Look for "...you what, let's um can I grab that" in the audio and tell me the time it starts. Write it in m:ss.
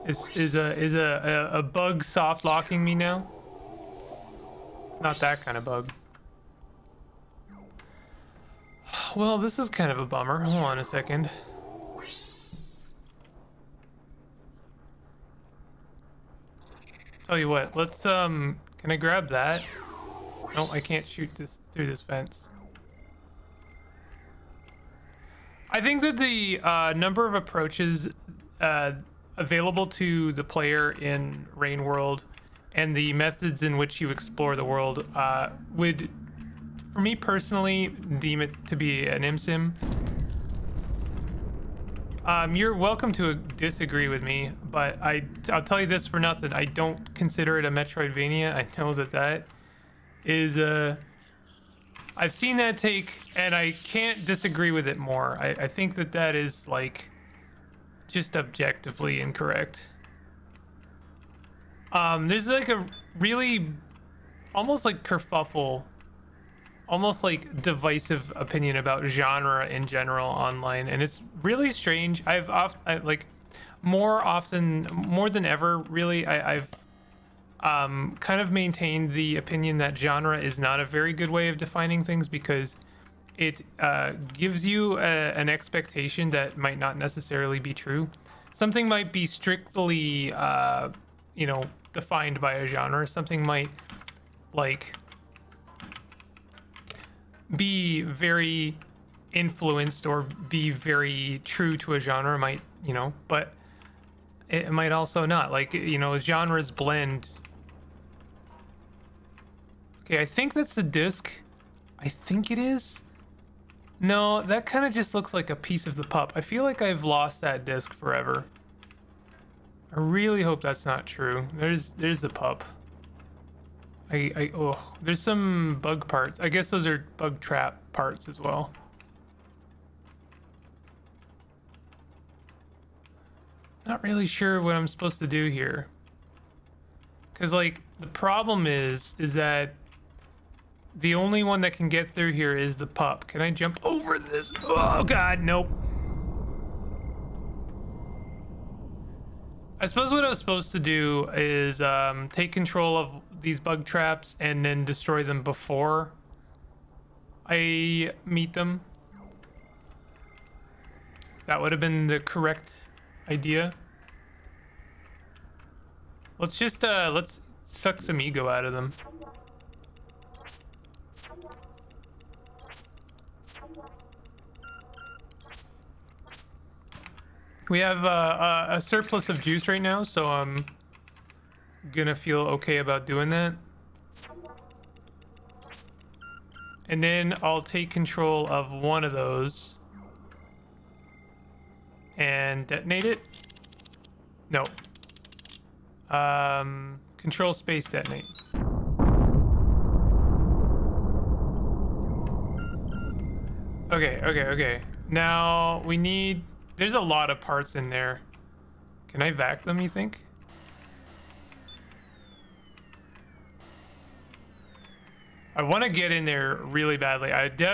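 0:17.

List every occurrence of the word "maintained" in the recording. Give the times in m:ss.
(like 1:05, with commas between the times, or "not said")
1:18.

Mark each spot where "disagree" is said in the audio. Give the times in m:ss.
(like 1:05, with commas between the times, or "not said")
0:43, 0:54.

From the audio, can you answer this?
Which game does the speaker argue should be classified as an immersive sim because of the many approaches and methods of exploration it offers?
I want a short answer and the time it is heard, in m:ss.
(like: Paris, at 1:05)
Rain World, at 0:31.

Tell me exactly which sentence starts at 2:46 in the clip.
Let's just, uh, let's suck some ego out of them.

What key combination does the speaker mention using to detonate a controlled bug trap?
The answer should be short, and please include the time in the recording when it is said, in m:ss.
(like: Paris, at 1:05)
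Control space, at 3:17.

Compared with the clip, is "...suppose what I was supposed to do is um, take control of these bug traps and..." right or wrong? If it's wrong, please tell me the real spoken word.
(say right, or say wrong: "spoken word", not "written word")
right.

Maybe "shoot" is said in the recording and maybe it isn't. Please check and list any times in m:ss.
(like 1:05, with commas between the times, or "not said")
0:21.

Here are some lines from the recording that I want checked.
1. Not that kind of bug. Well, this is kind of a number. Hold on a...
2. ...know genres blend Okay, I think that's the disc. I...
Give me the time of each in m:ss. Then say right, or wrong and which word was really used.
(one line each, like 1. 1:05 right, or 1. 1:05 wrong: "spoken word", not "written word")
1. 0:04 wrong: "bummer", not "number"
2. 1:45 right.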